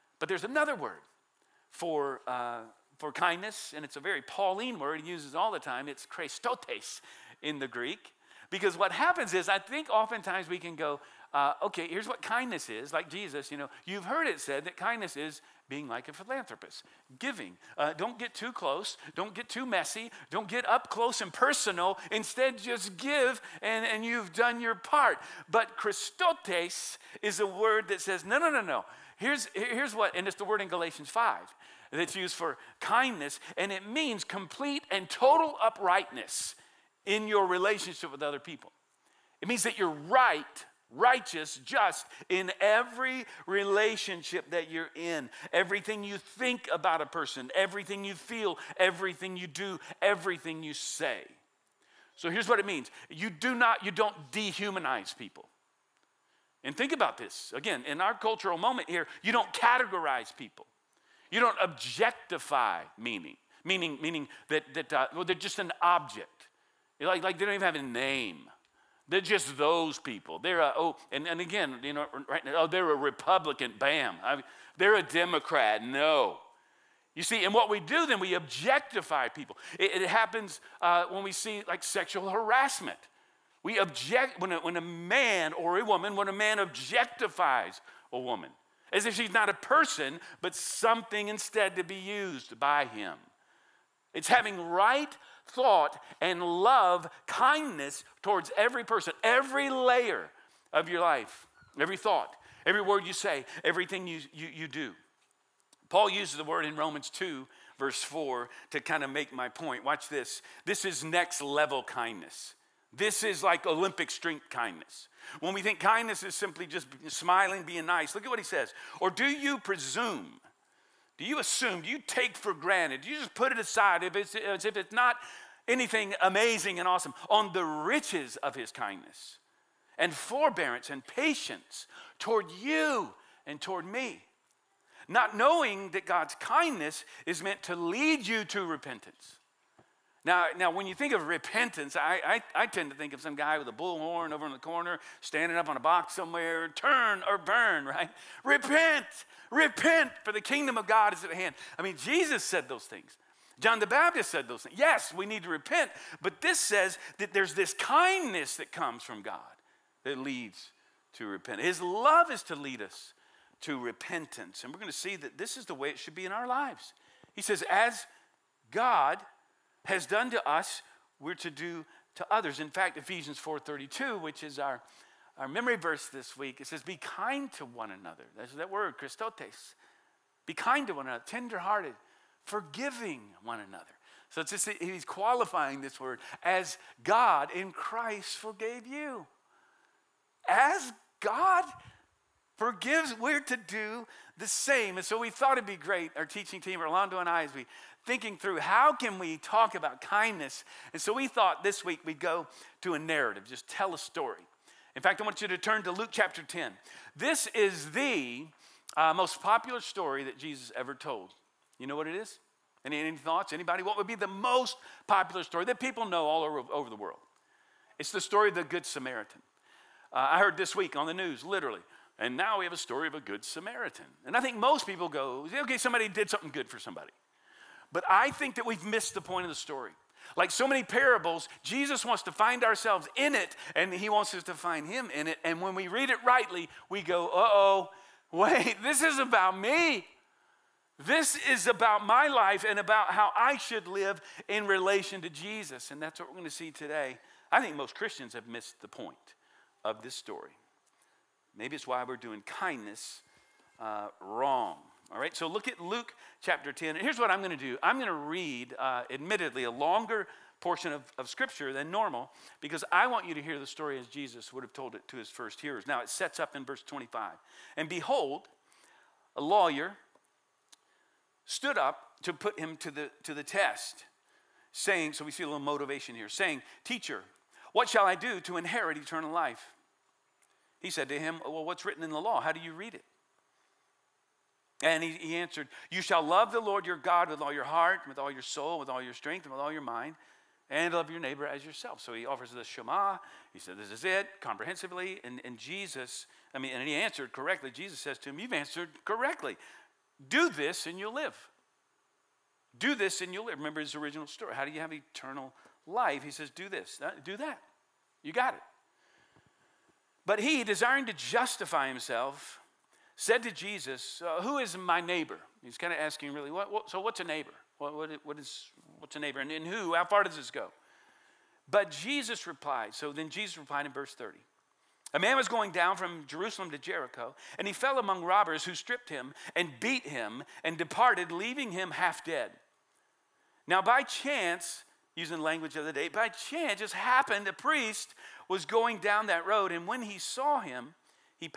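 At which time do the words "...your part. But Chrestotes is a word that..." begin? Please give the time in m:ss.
0:24.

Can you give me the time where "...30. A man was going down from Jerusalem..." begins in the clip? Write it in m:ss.
5:24.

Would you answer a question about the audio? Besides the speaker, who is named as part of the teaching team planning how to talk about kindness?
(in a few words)
Orlando.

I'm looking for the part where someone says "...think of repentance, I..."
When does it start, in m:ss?
2:20.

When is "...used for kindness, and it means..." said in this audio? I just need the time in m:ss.
0:32.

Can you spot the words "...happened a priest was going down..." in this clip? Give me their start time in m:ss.
5:36.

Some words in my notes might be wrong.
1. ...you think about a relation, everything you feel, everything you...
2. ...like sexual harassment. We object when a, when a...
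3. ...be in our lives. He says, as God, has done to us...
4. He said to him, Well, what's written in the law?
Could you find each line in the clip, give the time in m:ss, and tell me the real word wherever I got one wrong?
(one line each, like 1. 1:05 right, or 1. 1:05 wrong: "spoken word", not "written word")
1. 0:46 wrong: "person", not "relation"
2. 1:21 right
3. 2:46 right
4. 4:40 right.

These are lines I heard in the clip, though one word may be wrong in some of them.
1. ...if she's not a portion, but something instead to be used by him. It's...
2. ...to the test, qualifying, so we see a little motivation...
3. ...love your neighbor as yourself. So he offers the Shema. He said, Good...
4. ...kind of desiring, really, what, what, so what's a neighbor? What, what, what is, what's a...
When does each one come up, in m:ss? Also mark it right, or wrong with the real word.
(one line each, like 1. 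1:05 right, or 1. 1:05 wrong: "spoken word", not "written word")
1. 1:29 wrong: "person", not "portion"
2. 4:33 wrong: "saying", not "qualifying"
3. 4:50 wrong: "This", not "Good"
4. 5:15 wrong: "asking", not "desiring".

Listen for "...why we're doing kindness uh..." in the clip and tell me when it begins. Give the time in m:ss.
4:11.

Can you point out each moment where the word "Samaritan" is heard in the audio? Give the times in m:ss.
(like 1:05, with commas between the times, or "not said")
3:38, 3:43.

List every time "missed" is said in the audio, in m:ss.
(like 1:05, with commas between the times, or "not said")
3:48, 4:08.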